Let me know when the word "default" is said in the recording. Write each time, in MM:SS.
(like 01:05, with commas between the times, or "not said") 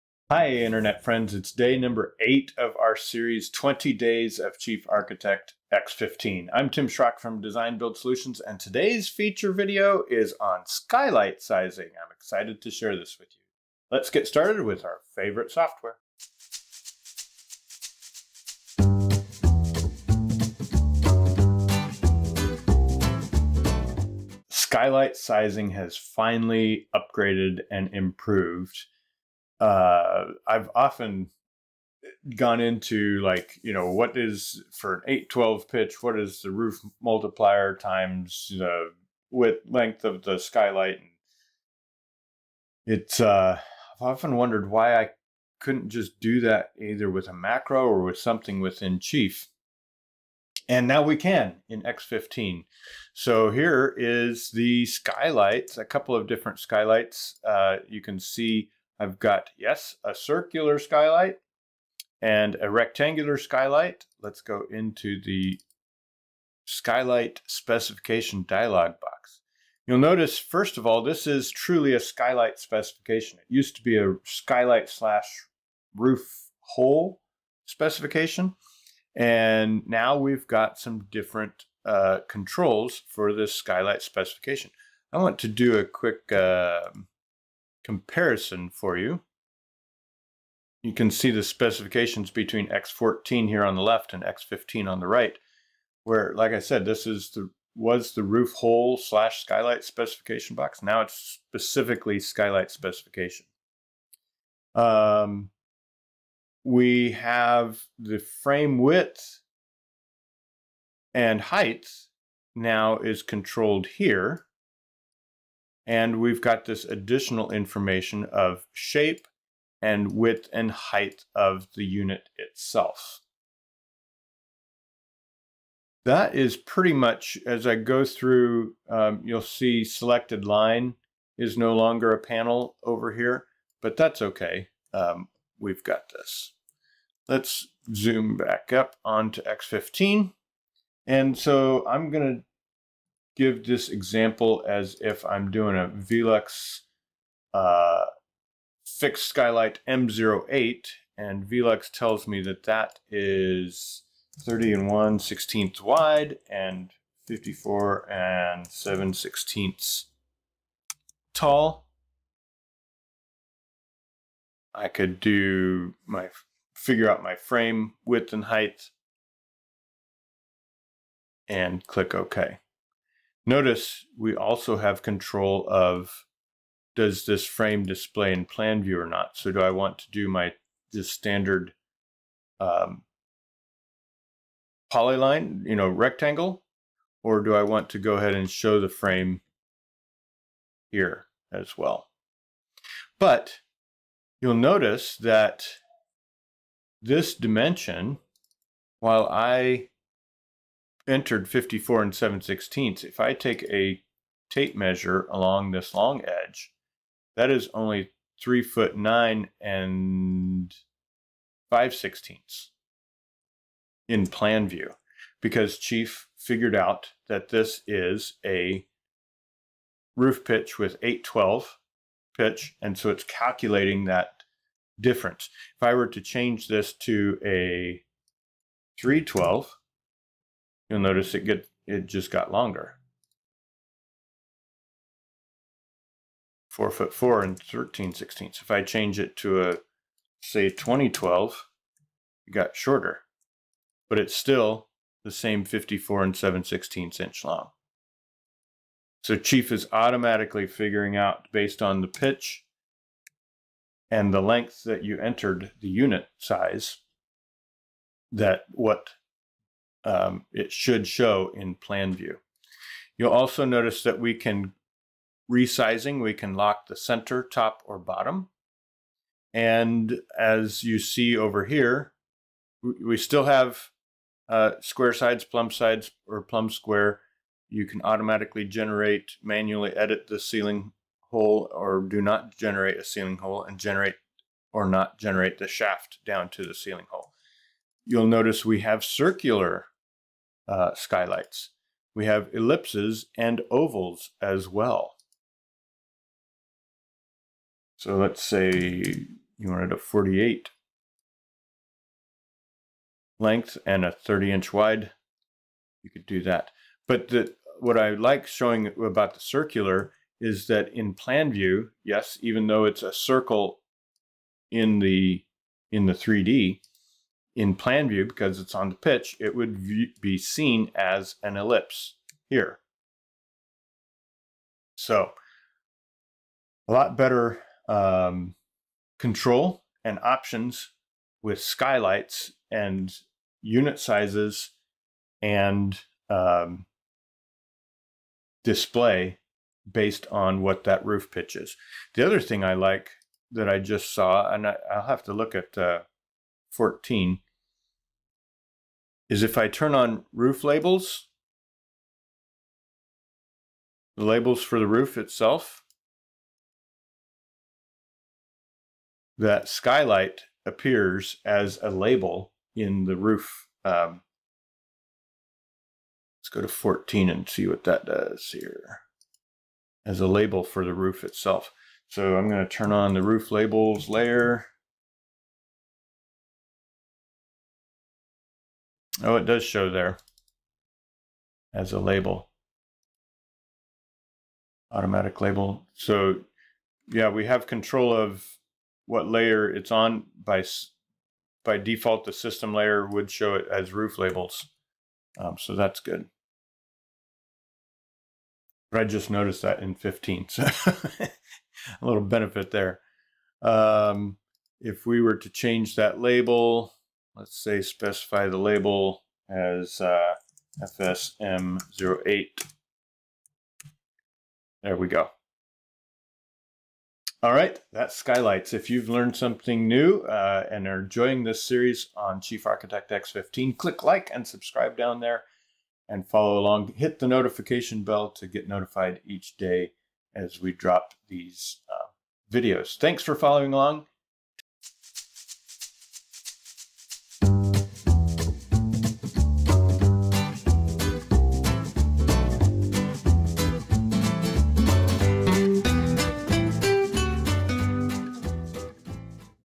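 06:31.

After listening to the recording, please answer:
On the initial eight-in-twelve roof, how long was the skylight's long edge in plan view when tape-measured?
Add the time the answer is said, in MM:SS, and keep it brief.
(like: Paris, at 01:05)
3 foot 9 5/16, at 03:28.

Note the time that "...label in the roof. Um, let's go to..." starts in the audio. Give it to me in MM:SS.
06:01.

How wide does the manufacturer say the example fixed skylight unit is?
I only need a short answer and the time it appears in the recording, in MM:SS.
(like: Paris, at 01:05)
30 1/16 inches, at 02:34.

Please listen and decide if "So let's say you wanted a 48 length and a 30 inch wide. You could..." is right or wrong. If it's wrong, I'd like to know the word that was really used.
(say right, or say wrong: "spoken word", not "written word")
right.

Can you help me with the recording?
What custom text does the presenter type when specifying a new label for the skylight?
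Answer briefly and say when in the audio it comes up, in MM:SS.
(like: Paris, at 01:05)
FSM08, at 06:50.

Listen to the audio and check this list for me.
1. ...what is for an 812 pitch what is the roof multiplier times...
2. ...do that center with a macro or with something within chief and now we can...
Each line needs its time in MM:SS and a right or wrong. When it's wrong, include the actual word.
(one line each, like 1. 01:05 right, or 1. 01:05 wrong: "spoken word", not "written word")
1. 00:33 right
2. 00:46 wrong: "either", not "center".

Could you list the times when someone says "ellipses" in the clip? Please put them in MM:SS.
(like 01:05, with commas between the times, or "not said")
04:52, 05:21.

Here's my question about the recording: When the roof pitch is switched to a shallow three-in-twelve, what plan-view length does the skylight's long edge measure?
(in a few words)
4 foot 4 13/16.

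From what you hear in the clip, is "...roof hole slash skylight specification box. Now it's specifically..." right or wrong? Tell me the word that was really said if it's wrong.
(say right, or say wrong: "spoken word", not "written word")
right.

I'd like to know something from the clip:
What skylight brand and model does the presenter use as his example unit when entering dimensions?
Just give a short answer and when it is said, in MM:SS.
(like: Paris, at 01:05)
VELUX M08, at 02:25.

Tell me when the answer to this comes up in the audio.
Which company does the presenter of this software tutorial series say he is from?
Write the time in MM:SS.
00:07.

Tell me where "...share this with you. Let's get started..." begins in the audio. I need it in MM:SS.
00:12.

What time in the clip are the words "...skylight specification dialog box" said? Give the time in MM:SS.
01:06.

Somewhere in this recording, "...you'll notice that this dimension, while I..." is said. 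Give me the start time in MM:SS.
03:14.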